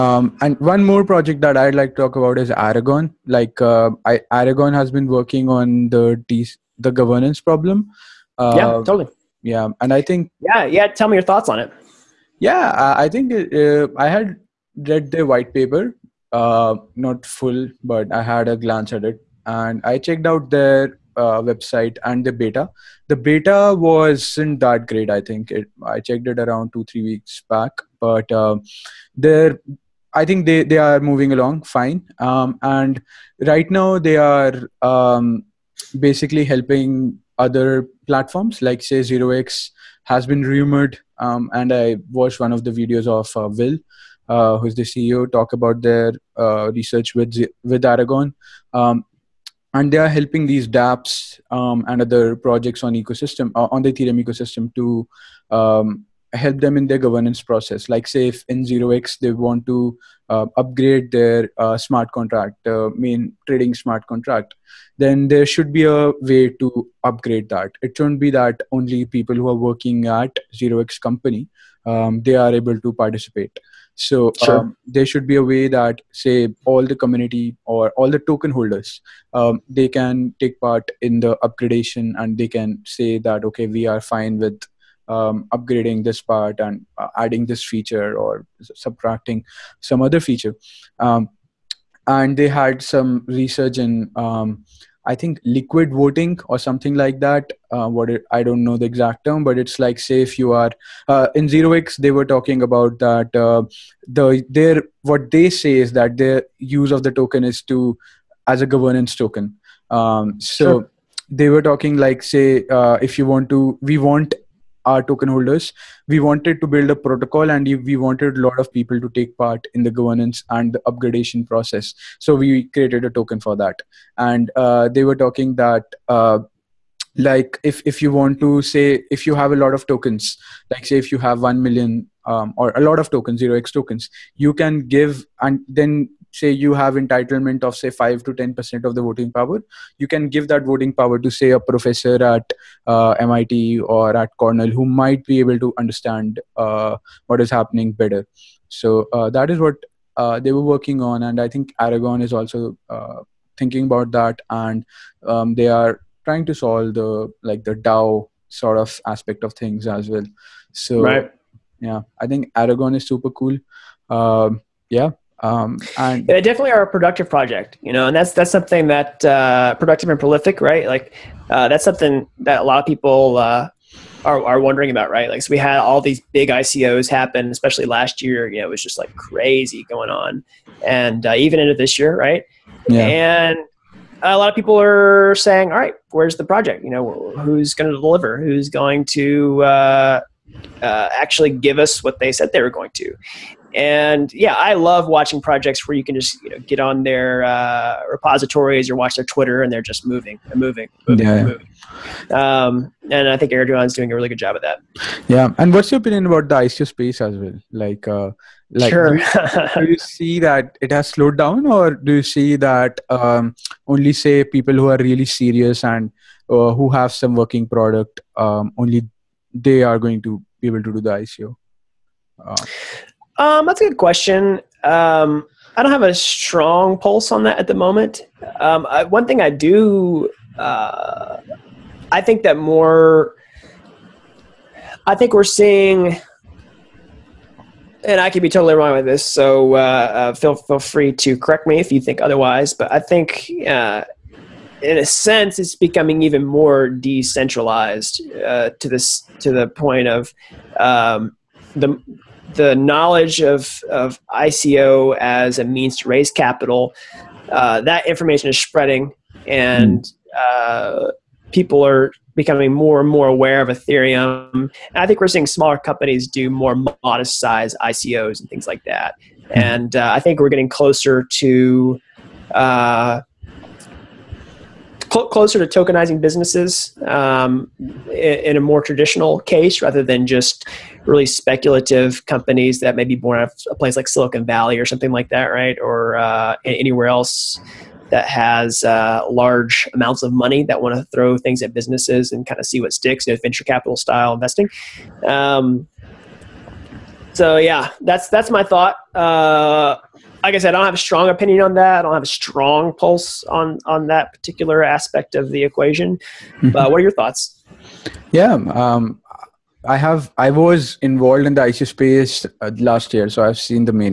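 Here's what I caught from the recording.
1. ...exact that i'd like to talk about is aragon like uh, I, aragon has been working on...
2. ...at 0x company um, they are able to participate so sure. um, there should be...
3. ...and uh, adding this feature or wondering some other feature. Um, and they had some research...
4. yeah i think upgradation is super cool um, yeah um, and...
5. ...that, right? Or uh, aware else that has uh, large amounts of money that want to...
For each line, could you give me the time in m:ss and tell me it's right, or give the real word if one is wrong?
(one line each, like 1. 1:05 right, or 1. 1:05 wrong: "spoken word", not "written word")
1. 0:01 wrong: "project", not "exact"
2. 1:10 right
3. 1:26 wrong: "subtracting", not "wondering"
4. 2:41 wrong: "aragon", not "upgradation"
5. 4:45 wrong: "anywhere", not "aware".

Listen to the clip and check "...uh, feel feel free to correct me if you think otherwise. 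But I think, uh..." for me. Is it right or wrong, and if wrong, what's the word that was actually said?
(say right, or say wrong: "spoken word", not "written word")
right.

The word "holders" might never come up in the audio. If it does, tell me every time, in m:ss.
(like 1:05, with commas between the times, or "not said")
1:18, 1:55.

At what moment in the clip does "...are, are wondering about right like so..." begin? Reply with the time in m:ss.
2:54.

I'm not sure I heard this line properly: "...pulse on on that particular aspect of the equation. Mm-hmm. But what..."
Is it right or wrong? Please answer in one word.
right.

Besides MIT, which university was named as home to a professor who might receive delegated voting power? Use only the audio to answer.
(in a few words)
Cornell.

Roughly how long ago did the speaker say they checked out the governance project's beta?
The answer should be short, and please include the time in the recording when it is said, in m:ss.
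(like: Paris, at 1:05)
2-3 weeks, at 0:26.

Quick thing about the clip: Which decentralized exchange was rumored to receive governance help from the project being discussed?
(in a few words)
0x.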